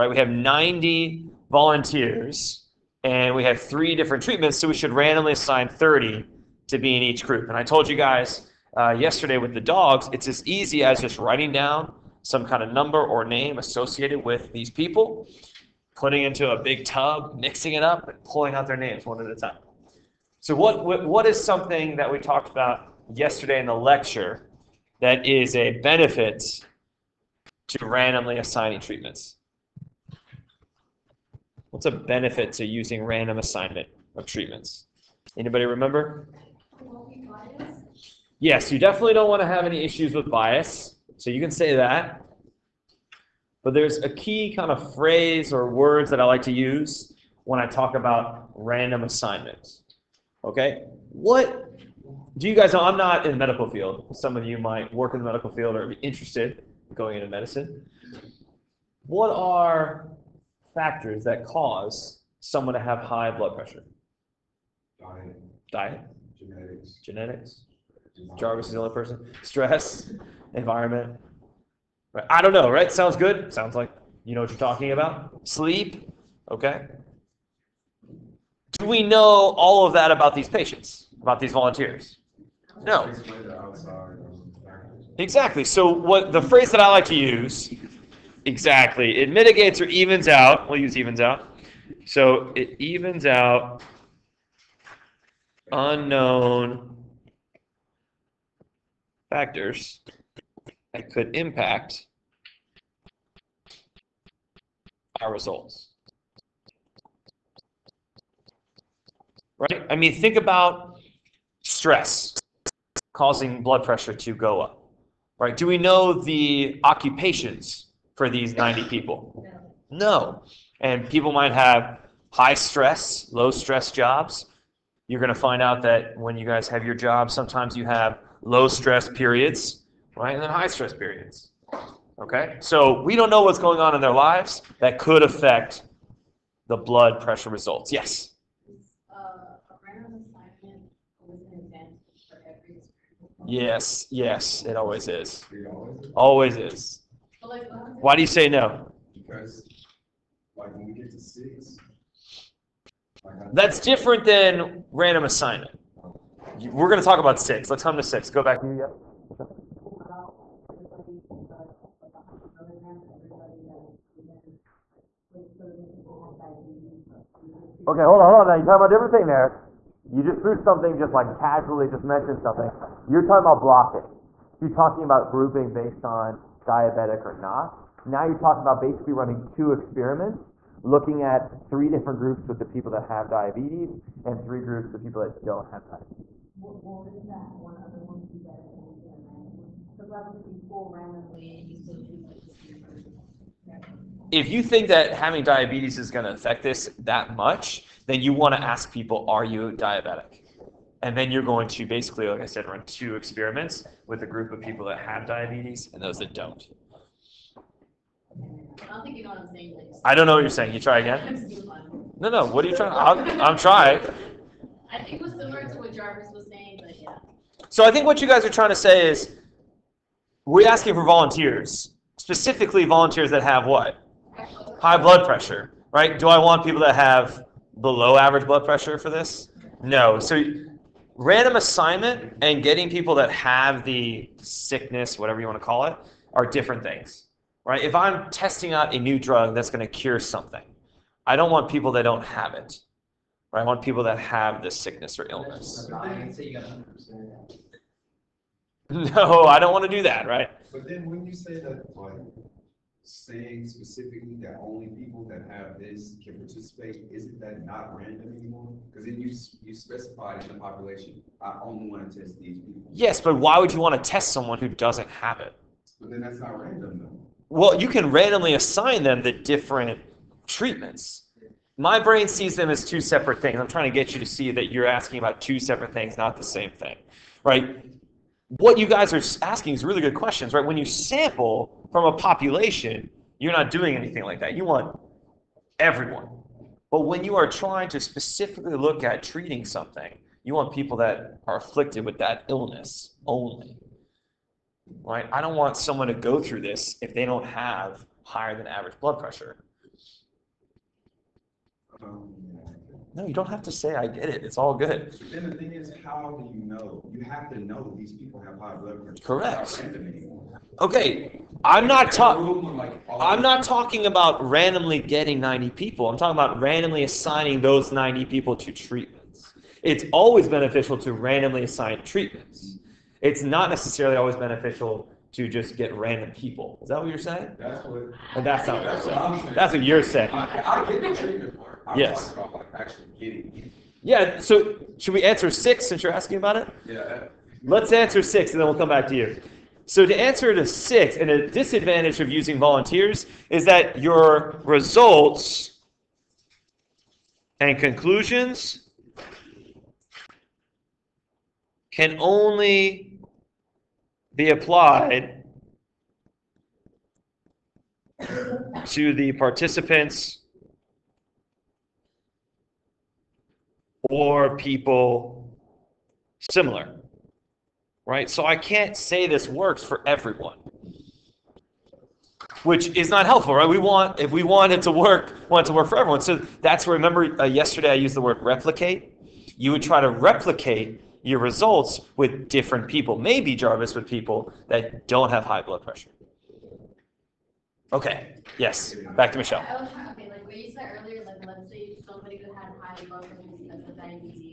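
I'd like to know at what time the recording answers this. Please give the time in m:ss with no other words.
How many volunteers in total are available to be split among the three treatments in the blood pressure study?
0:00.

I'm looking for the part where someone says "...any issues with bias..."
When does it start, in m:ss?
0:39.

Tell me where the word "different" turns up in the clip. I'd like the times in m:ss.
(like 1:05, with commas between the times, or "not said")
0:03, 2:33, 2:48, 3:01, 3:56, 4:29, 6:22.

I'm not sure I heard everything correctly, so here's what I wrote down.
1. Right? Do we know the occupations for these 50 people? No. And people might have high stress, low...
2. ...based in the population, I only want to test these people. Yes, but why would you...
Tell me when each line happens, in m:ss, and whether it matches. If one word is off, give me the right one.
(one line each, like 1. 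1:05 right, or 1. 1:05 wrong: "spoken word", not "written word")
1. 1:55 wrong: "90", not "50"
2. 4:19 wrong: "specified", not "based".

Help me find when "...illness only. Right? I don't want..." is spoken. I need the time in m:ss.
4:52.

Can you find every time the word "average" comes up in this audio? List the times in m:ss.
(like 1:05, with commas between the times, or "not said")
3:48, 4:58.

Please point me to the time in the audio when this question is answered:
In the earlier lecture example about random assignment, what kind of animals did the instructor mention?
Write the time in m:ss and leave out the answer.
0:09.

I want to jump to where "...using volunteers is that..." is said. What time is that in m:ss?
5:42.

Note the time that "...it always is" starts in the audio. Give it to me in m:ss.
2:24.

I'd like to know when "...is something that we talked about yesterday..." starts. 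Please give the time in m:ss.
0:21.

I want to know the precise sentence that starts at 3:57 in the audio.
If I'm testing out a new drug that's going to cure something, I don't want people that don't have it.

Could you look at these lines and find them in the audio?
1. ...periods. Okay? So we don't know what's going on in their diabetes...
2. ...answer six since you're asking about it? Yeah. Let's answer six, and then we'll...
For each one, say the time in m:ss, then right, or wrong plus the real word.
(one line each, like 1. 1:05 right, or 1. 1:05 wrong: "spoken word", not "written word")
1. 2:10 wrong: "lives", not "diabetes"
2. 5:35 right.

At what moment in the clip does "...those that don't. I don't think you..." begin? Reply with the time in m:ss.
3:26.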